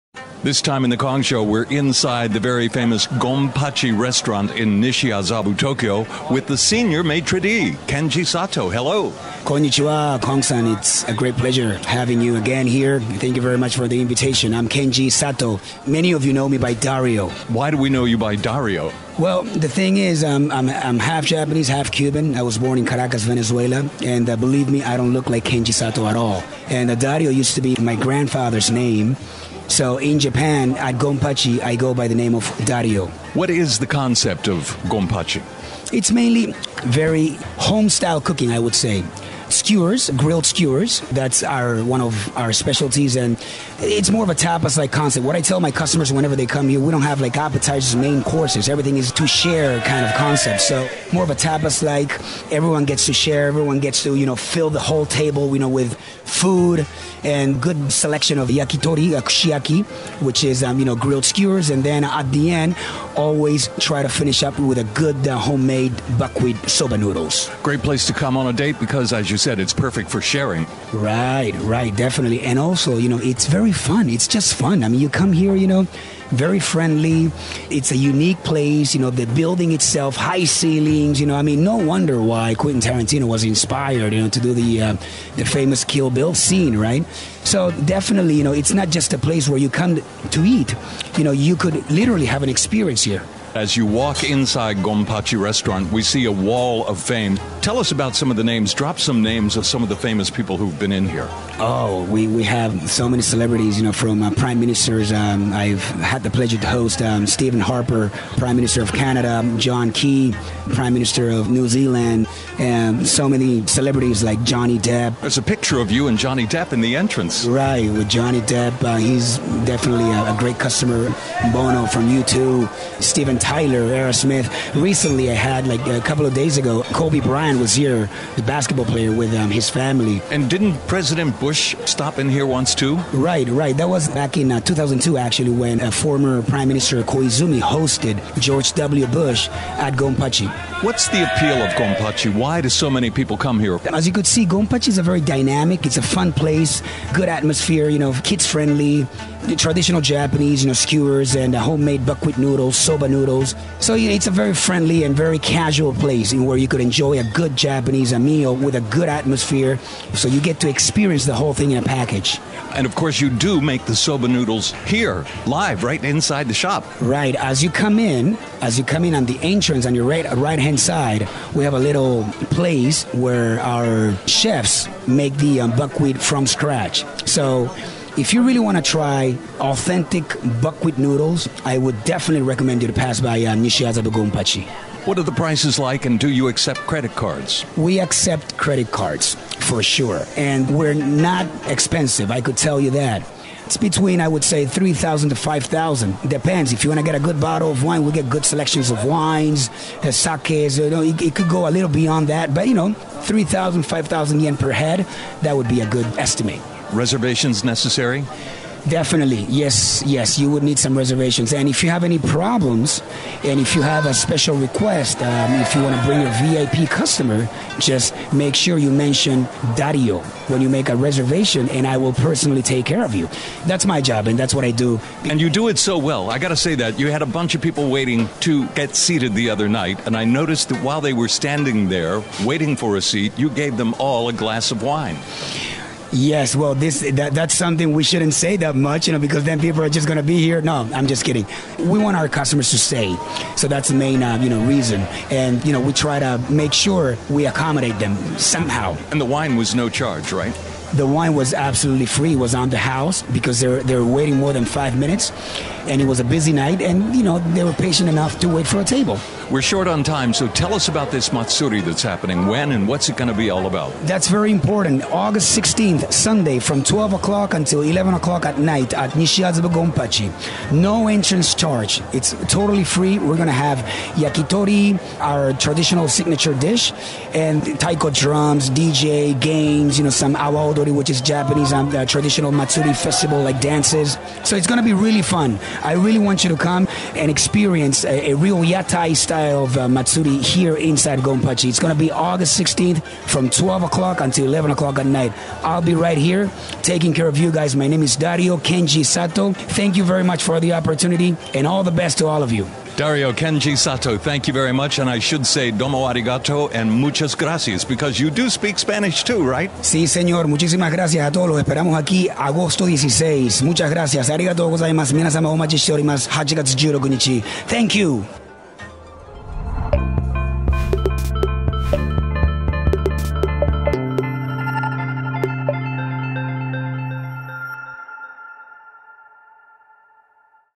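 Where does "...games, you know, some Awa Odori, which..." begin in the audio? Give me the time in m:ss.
4:39.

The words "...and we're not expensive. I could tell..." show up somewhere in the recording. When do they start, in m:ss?
3:10.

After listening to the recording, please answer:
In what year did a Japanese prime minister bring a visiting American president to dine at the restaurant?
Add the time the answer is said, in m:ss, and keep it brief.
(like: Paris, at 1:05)
2002, at 2:14.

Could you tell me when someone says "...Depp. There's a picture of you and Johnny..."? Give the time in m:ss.
1:54.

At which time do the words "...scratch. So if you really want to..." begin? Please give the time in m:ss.
2:56.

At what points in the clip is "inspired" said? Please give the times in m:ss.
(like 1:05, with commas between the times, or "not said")
1:23.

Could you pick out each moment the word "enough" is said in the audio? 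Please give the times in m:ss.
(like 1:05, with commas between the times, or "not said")
4:18.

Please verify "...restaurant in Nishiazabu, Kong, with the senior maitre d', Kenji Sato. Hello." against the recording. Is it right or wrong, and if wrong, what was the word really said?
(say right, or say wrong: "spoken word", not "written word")
wrong: "Tokyo", not "Kong".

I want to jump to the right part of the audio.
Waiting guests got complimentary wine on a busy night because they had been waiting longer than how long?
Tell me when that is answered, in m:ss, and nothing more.
4:14.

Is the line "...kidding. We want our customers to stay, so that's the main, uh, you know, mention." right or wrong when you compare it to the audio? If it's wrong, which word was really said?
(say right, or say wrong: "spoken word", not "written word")
wrong: "reason", not "mention".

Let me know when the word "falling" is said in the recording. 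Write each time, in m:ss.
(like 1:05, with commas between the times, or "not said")
not said.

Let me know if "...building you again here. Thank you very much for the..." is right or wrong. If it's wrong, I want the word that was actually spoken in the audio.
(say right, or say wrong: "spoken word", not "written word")
wrong: "having", not "building".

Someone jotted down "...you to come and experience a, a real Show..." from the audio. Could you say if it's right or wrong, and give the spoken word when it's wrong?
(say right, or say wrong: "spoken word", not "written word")
wrong: "Yatai", not "Show".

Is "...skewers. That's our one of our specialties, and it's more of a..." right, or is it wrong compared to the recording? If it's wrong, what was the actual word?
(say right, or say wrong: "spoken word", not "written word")
right.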